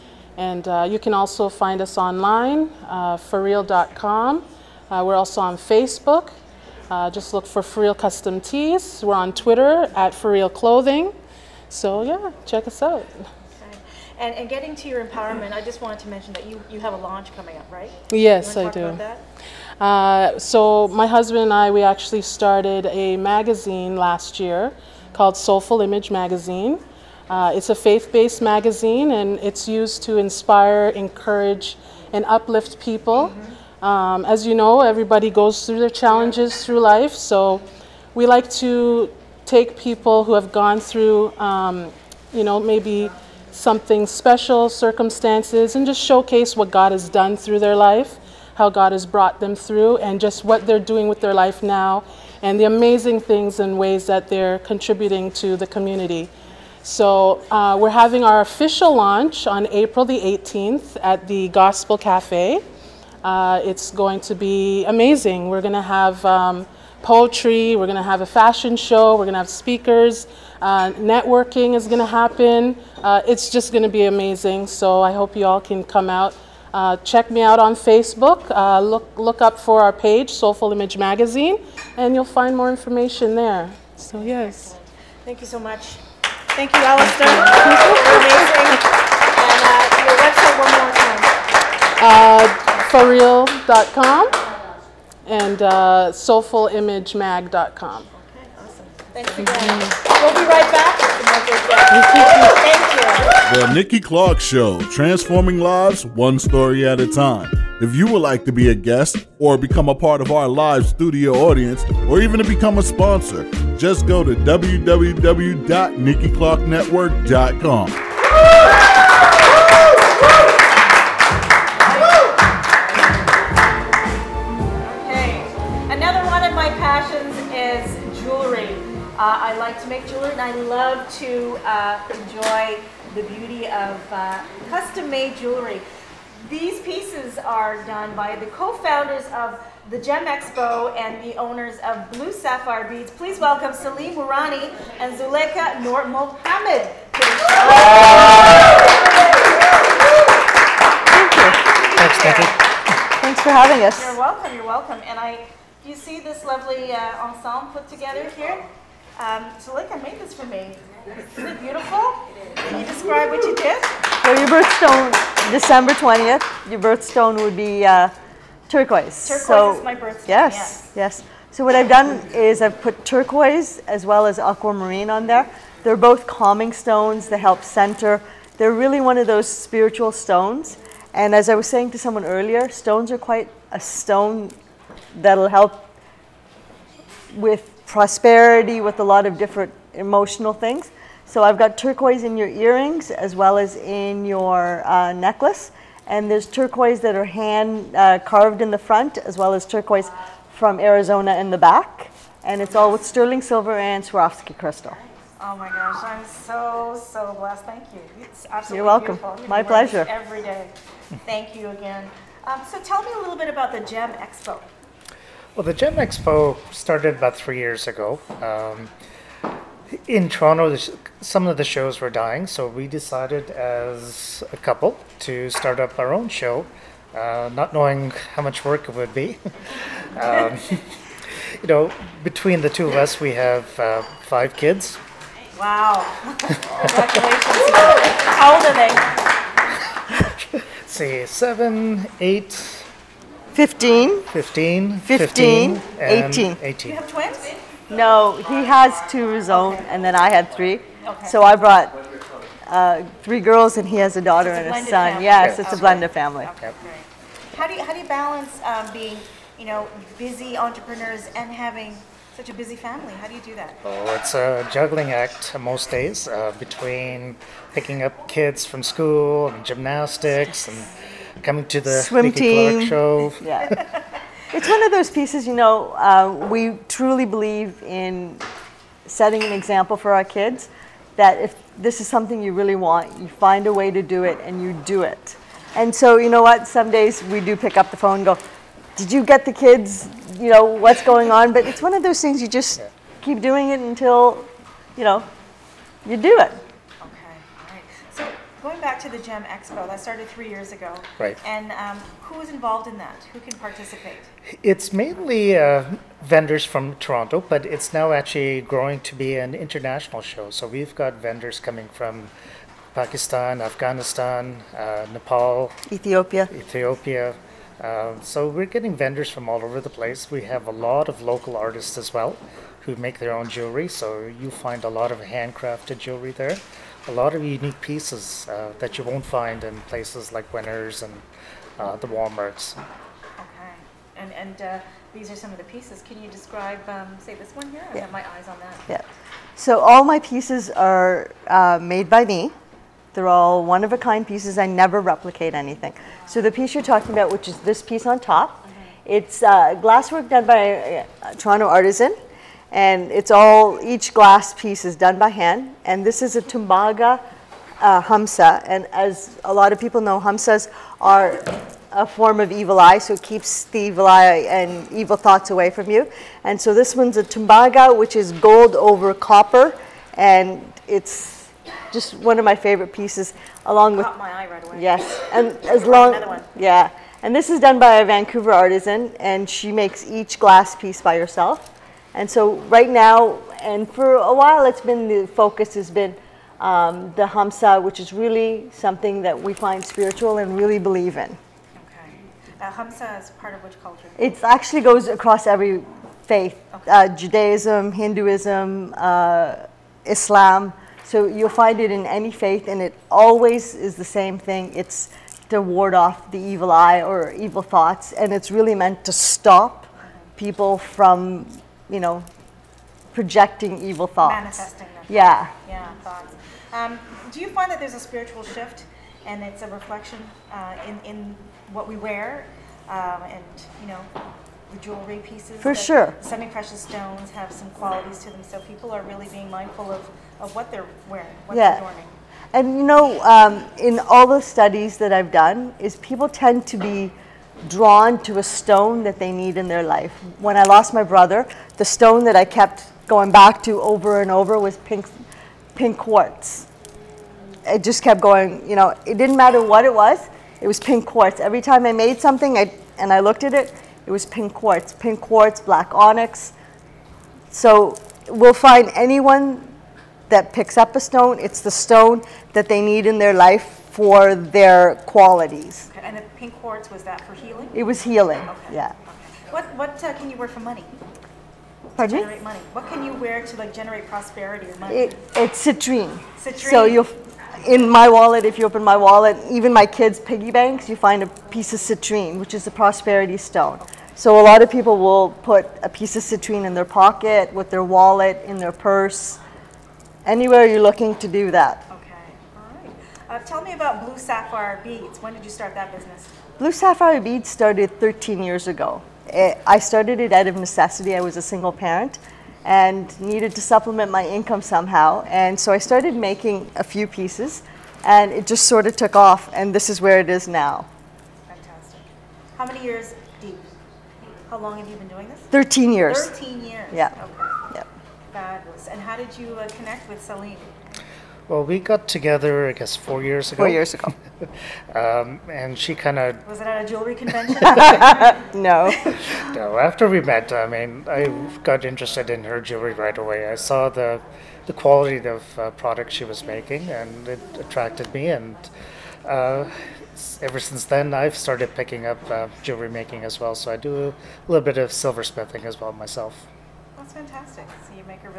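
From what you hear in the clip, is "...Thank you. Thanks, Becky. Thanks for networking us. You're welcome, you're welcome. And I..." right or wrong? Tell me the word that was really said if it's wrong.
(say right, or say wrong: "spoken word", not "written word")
wrong: "having", not "networking".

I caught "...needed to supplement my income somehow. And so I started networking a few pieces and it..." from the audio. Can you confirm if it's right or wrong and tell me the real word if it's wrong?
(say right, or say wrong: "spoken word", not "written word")
wrong: "making", not "networking".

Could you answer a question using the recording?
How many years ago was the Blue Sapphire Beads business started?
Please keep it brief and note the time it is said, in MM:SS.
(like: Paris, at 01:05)
13, at 08:17.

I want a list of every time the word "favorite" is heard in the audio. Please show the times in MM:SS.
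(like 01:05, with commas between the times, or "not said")
06:12.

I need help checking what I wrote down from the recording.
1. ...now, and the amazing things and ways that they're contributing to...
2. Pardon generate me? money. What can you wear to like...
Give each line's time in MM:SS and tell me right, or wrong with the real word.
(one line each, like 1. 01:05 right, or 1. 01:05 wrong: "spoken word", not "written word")
1. 00:51 right
2. 07:51 right.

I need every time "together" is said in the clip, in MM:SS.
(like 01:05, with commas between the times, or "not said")
02:37, 08:42.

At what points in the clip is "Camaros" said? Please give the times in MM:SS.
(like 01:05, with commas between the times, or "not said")
not said.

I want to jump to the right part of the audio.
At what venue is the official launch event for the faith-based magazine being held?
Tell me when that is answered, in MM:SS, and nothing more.
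01:01.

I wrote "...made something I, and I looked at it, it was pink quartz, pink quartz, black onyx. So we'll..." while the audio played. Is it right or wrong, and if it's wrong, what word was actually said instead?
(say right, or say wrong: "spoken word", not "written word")
right.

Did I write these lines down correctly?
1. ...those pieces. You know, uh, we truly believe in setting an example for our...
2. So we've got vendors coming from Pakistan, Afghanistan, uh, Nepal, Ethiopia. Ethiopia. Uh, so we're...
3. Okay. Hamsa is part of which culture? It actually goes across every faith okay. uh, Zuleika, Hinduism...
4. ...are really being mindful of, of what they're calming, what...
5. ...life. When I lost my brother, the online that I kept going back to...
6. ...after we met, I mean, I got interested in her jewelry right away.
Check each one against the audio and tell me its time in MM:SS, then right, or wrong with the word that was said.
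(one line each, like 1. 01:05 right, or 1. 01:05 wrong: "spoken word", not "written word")
1. 04:34 right
2. 05:10 right
3. 06:31 wrong: "Judaism", not "Zuleika"
4. 07:08 wrong: "wearing", not "calming"
5. 07:19 wrong: "stone", not "online"
6. 08:49 right.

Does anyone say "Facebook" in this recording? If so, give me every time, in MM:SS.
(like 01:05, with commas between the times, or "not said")
00:05, 01:17.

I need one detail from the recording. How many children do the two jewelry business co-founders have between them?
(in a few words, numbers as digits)
5.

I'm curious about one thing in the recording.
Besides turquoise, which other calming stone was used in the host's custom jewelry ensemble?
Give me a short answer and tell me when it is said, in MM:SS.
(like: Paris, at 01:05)
aquamarine, at 02:54.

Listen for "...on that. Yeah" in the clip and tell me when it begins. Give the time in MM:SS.
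05:38.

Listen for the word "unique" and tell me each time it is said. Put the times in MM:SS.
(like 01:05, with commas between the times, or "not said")
05:27.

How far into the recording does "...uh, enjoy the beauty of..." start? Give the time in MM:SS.
02:11.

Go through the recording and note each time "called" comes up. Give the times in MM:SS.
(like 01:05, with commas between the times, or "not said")
00:25.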